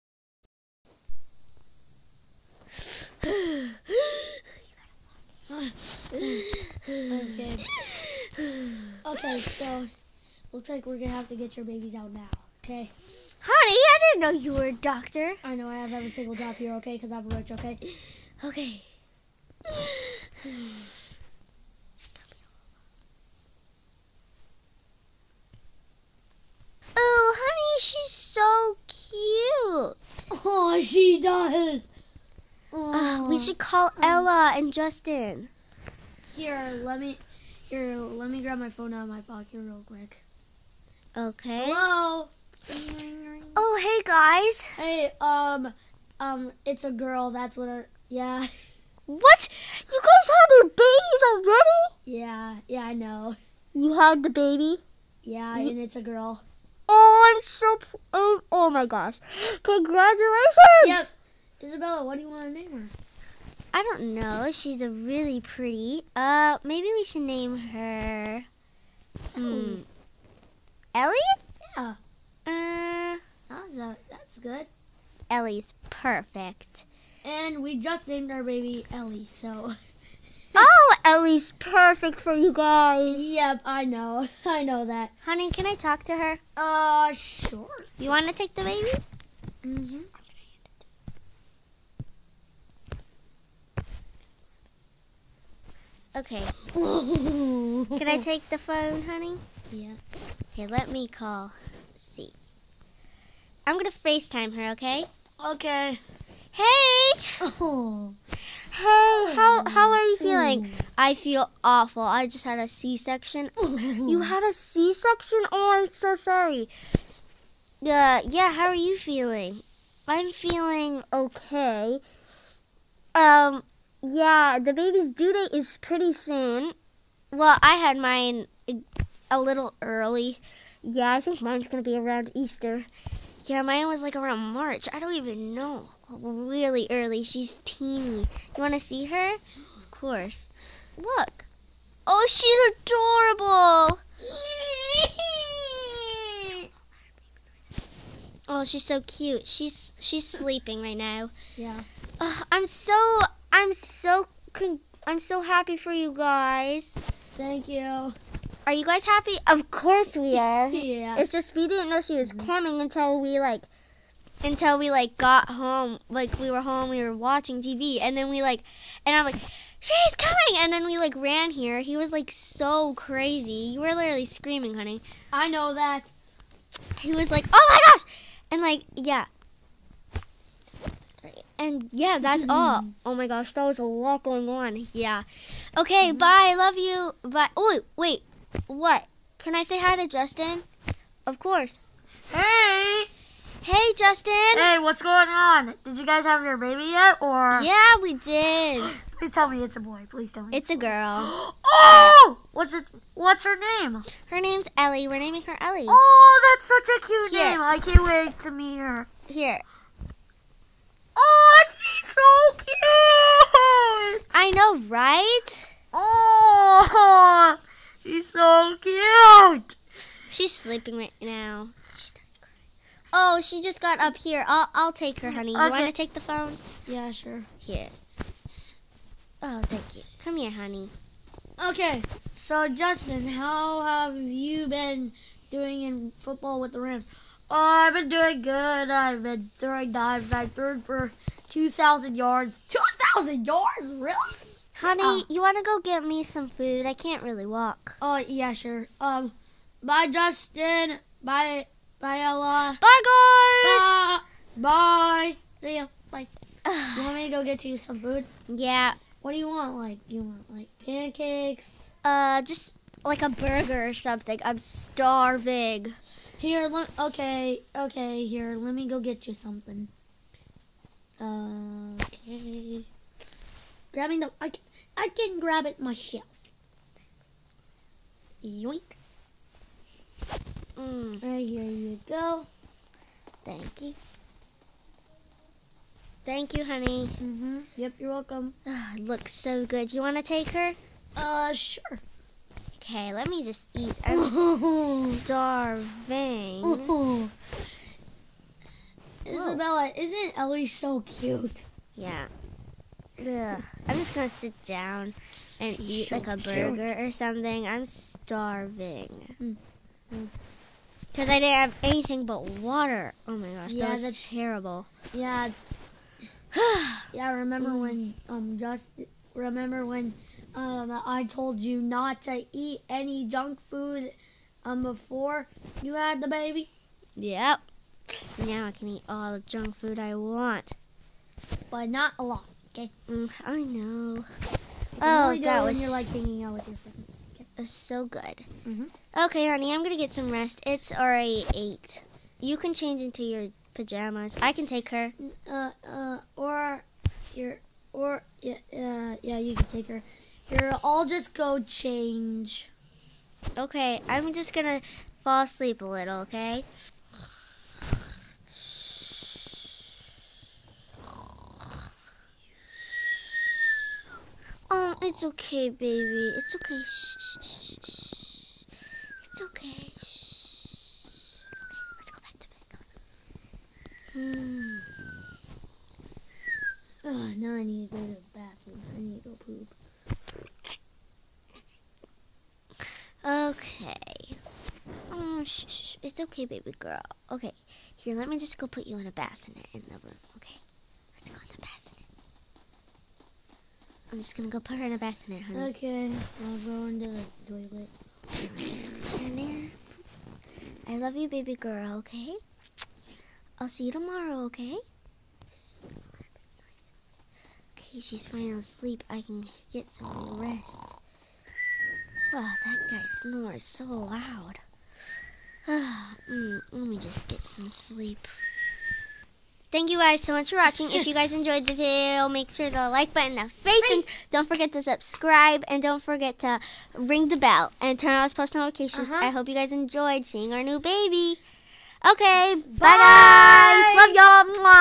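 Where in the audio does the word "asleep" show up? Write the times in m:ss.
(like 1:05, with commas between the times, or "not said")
5:55, 6:48.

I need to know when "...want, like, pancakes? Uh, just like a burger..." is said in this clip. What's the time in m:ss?
4:20.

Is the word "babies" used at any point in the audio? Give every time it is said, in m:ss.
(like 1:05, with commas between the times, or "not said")
0:11, 0:50.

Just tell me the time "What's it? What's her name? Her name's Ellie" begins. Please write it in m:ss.
3:22.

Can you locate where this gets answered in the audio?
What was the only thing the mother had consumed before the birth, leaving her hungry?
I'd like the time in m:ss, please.
5:12.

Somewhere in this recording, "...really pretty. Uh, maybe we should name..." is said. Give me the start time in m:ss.
1:04.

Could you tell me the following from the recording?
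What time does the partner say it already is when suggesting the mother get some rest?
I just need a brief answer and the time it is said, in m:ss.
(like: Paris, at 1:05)
8, at 5:41.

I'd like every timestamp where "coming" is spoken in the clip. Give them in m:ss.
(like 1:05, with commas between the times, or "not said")
2:42, 2:50.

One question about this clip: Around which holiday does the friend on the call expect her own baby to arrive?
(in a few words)
Easter.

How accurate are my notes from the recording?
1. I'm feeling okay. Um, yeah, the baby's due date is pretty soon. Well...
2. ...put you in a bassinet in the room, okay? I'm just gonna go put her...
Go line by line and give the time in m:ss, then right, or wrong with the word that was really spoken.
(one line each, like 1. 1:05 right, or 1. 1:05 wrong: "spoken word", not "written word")
1. 2:00 right
2. 6:28 right.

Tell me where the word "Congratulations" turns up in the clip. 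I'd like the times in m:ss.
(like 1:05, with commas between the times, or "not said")
0:59.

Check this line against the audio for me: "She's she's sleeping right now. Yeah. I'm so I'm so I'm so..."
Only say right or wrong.
right.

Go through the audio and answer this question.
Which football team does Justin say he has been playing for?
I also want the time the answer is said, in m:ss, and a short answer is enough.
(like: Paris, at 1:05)
Rams, at 3:56.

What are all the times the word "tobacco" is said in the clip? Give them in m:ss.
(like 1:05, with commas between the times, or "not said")
not said.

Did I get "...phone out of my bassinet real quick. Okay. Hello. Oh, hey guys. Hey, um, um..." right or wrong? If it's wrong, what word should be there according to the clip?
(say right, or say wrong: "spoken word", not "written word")
wrong: "pocket", not "bassinet".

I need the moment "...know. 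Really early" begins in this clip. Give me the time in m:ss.
2:15.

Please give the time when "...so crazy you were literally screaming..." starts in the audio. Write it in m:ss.
2:52.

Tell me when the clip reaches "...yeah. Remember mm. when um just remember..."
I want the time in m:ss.
5:17.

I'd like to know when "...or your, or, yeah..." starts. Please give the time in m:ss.
5:46.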